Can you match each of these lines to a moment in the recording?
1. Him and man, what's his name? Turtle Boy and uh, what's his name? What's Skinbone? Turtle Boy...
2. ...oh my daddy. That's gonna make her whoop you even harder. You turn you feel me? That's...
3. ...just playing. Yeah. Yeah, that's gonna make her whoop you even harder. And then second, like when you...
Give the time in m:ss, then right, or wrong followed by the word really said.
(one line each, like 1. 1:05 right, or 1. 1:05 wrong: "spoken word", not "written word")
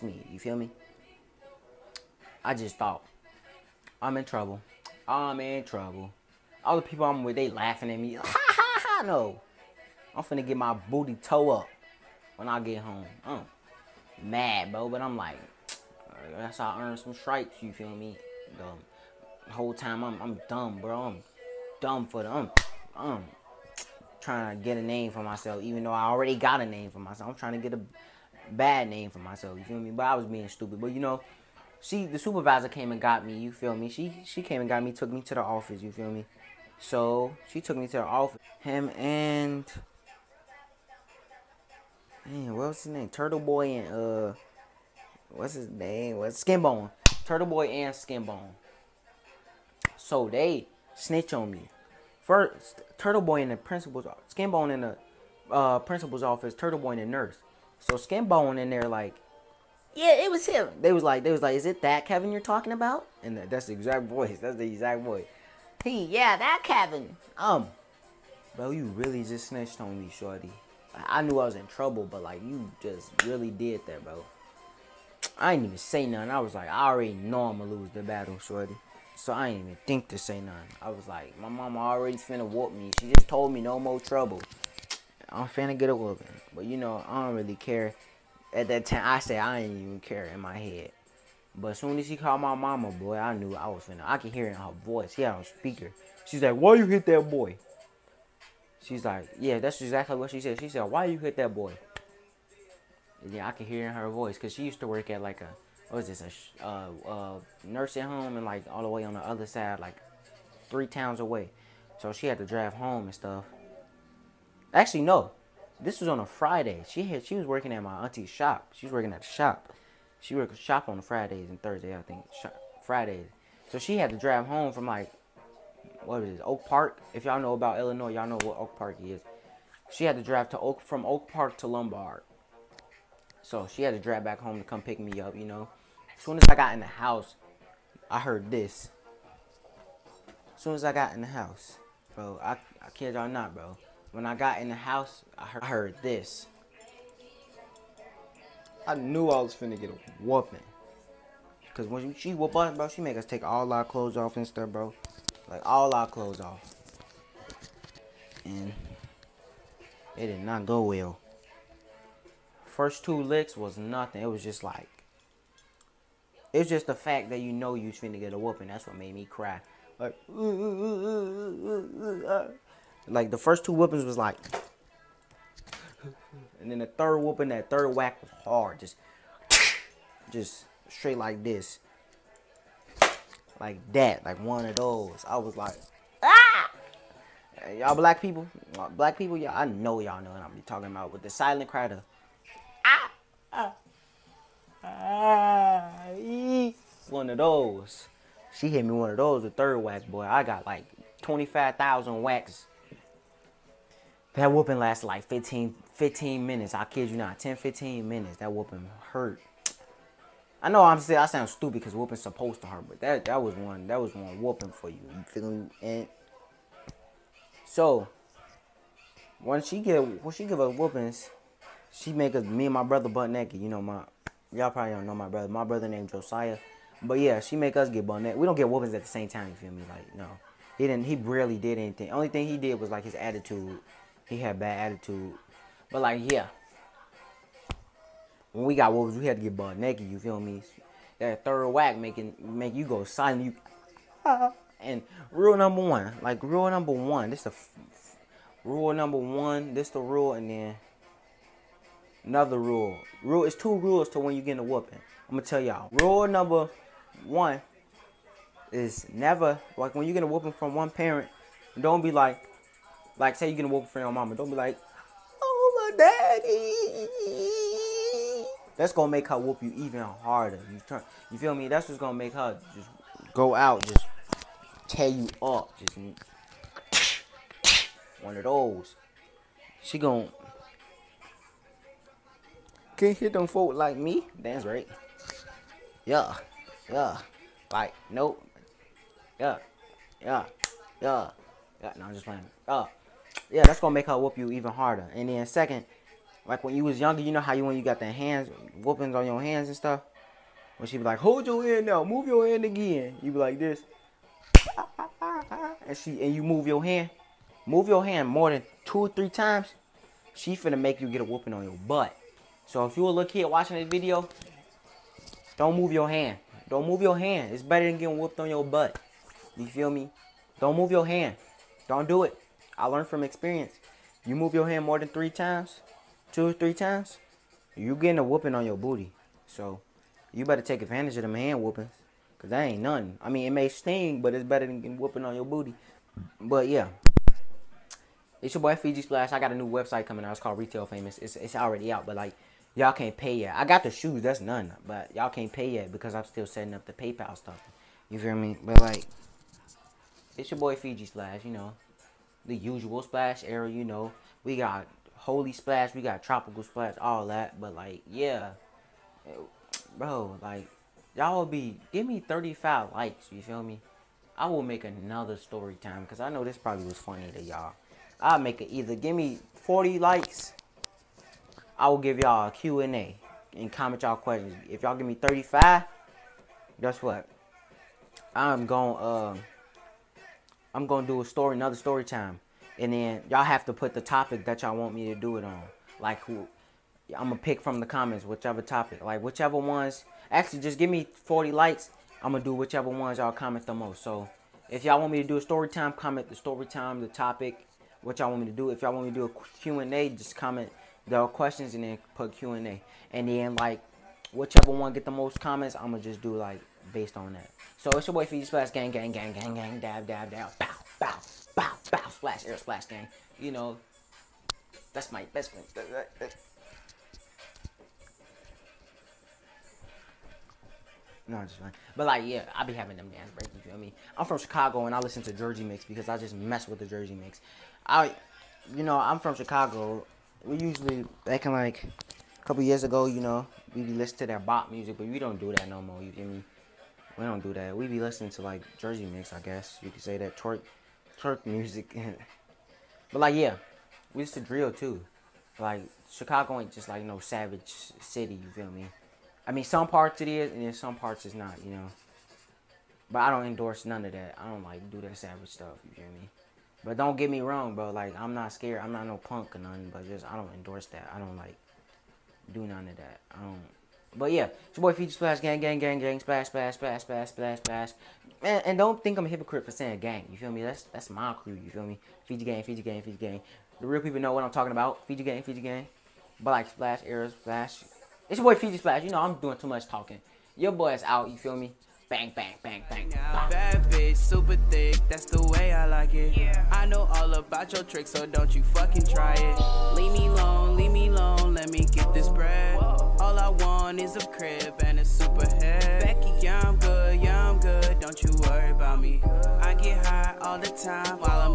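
1. 0:38 right
2. 4:25 right
3. 4:52 right.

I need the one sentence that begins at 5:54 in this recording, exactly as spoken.
We got Holy Splash, we got Tropical Splash, all that.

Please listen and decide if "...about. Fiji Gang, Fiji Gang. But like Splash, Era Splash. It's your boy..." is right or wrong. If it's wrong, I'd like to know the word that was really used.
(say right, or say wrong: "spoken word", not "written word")
right.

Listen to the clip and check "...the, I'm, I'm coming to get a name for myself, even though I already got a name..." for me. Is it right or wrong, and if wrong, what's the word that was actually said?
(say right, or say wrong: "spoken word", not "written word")
wrong: "trying", not "coming".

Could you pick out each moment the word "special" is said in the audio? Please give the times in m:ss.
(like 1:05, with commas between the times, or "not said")
not said.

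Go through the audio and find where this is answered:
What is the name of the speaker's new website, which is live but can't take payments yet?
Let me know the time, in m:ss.
5:40.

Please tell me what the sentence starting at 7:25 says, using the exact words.
Like Chicago ain't just like no savage city.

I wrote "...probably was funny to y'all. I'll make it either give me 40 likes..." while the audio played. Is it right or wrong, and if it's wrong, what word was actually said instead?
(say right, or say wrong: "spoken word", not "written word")
right.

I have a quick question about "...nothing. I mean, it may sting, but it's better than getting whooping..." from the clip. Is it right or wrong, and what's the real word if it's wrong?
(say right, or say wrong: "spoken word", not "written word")
right.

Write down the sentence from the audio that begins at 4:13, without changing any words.
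Rule it's two rules to when you get a whooping.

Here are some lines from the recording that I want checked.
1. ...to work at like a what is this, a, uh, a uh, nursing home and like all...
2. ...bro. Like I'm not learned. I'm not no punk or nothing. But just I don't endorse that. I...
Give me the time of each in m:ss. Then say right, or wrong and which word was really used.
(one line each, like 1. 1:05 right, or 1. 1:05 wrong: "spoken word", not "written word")
1. 1:44 right
2. 7:37 wrong: "scared", not "learned".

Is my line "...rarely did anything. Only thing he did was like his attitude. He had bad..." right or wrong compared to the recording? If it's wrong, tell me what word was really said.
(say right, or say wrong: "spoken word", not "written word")
right.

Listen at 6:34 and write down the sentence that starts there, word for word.
So if y'all want me to do a story time, comment the story time, the topic, what y'all want me to do.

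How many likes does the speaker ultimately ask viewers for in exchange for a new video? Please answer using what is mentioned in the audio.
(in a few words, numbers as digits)
40.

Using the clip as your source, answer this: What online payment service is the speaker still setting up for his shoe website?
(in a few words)
PayPal.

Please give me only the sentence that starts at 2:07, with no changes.
If y'all know about Illinois, y'all know what Oak Park is.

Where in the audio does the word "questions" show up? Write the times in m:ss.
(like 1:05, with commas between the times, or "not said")
6:14, 6:41.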